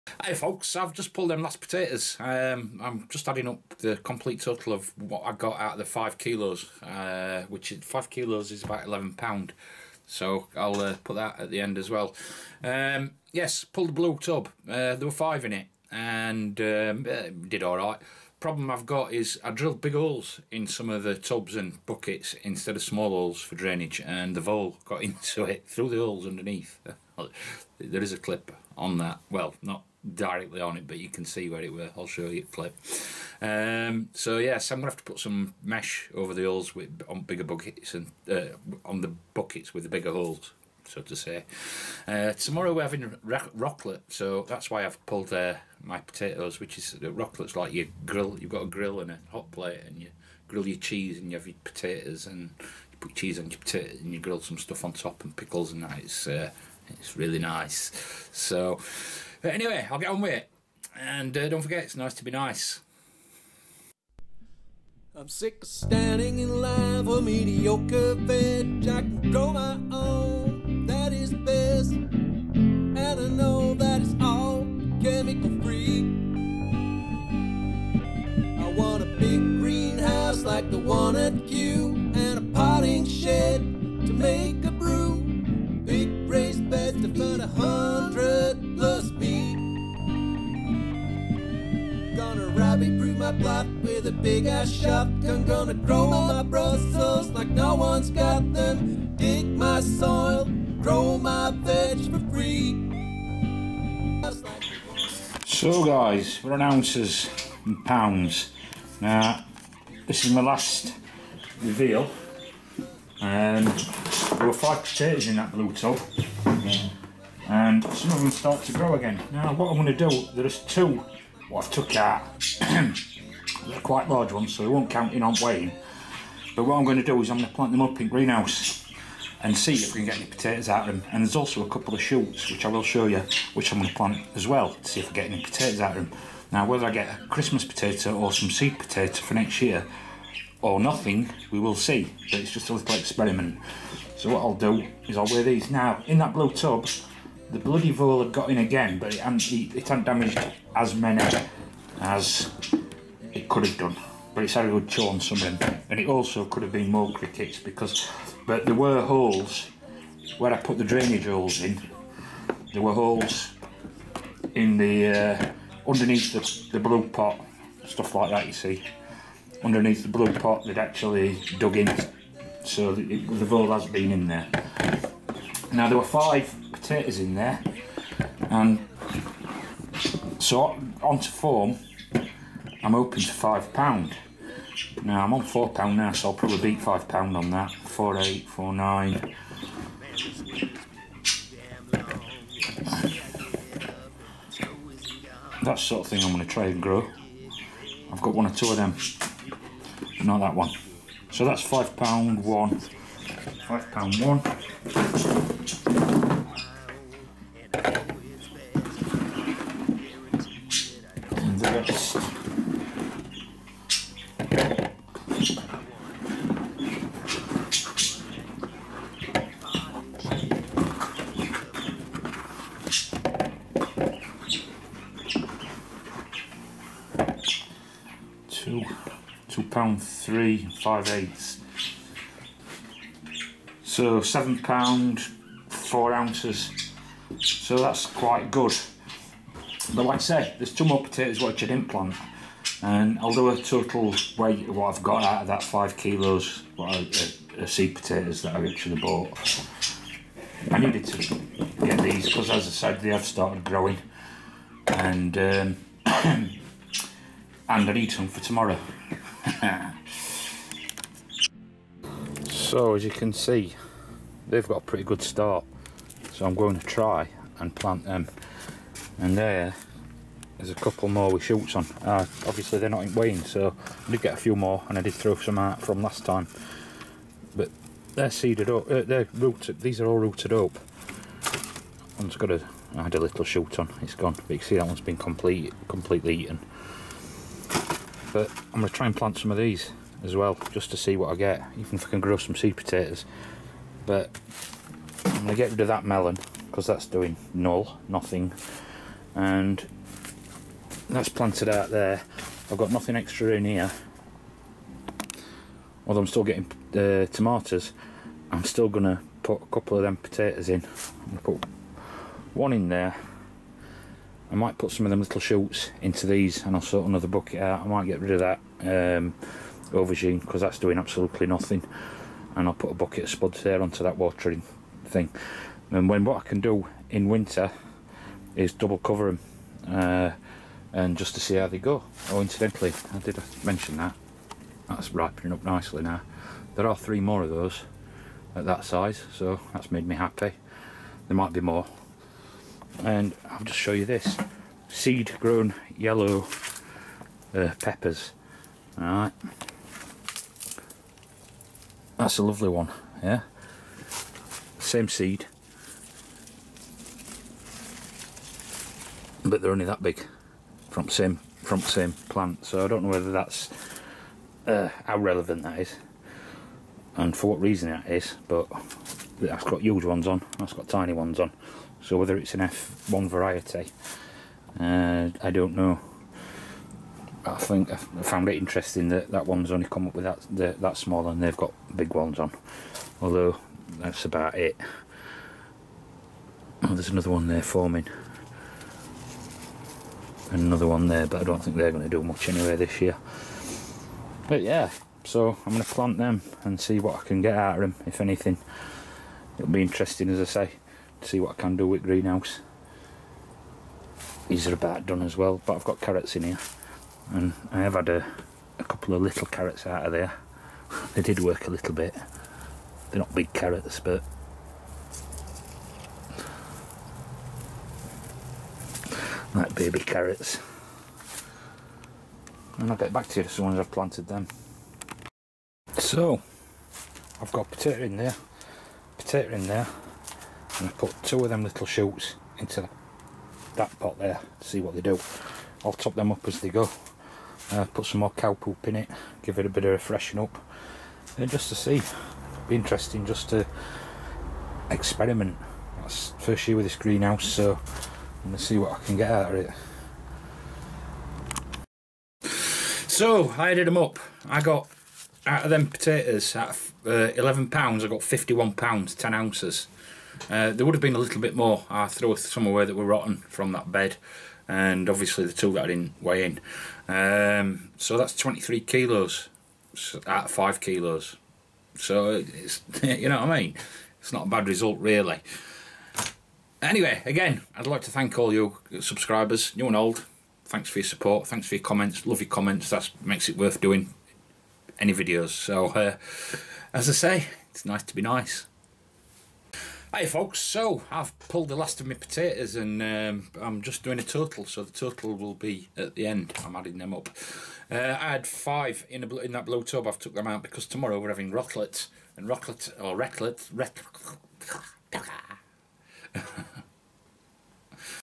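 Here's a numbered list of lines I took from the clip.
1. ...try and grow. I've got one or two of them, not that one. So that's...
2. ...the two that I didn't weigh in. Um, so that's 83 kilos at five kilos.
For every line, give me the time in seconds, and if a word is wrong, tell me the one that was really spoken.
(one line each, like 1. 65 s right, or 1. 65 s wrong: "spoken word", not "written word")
1. 196 s right
2. 465 s wrong: "23", not "83".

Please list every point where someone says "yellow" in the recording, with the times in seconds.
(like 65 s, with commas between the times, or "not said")
345 s.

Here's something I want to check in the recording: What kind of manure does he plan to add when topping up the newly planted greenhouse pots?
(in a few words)
cow poop.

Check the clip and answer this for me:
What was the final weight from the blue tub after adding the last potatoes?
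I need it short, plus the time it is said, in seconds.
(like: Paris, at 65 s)
7 pounds 4 ounces, at 234 s.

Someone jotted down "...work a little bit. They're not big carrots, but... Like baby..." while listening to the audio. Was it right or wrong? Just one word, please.
right.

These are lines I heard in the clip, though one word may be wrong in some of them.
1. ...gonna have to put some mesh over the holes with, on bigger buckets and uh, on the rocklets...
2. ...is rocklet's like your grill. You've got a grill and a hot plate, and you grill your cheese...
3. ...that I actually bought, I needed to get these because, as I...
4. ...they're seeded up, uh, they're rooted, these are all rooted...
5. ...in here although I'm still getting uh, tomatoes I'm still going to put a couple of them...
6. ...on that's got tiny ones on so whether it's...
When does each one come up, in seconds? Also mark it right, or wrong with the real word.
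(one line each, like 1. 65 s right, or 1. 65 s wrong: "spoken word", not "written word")
1. 34 s wrong: "buckets", not "rocklets"
2. 46 s right
3. 248 s right
4. 278 s right
5. 303 s right
6. 370 s right.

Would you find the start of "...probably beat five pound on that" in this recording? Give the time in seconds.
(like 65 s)
186 s.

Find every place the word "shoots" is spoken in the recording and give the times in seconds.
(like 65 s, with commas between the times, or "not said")
132 s, 271 s, 283 s, 315 s, 431 s.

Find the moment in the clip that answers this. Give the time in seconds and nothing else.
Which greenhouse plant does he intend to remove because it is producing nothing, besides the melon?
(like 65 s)
319 s.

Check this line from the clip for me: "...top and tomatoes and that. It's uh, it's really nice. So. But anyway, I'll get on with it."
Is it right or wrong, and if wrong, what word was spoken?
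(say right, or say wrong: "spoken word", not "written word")
wrong: "pickles", not "tomatoes".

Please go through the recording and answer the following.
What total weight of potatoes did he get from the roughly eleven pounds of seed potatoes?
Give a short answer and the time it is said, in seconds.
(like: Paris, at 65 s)
51 pounds 10 ounces, at 458 s.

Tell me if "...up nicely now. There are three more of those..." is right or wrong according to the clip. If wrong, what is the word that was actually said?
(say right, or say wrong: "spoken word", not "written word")
right.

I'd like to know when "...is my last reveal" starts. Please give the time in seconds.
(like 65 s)
110 s.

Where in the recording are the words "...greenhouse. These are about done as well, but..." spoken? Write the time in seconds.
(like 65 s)
402 s.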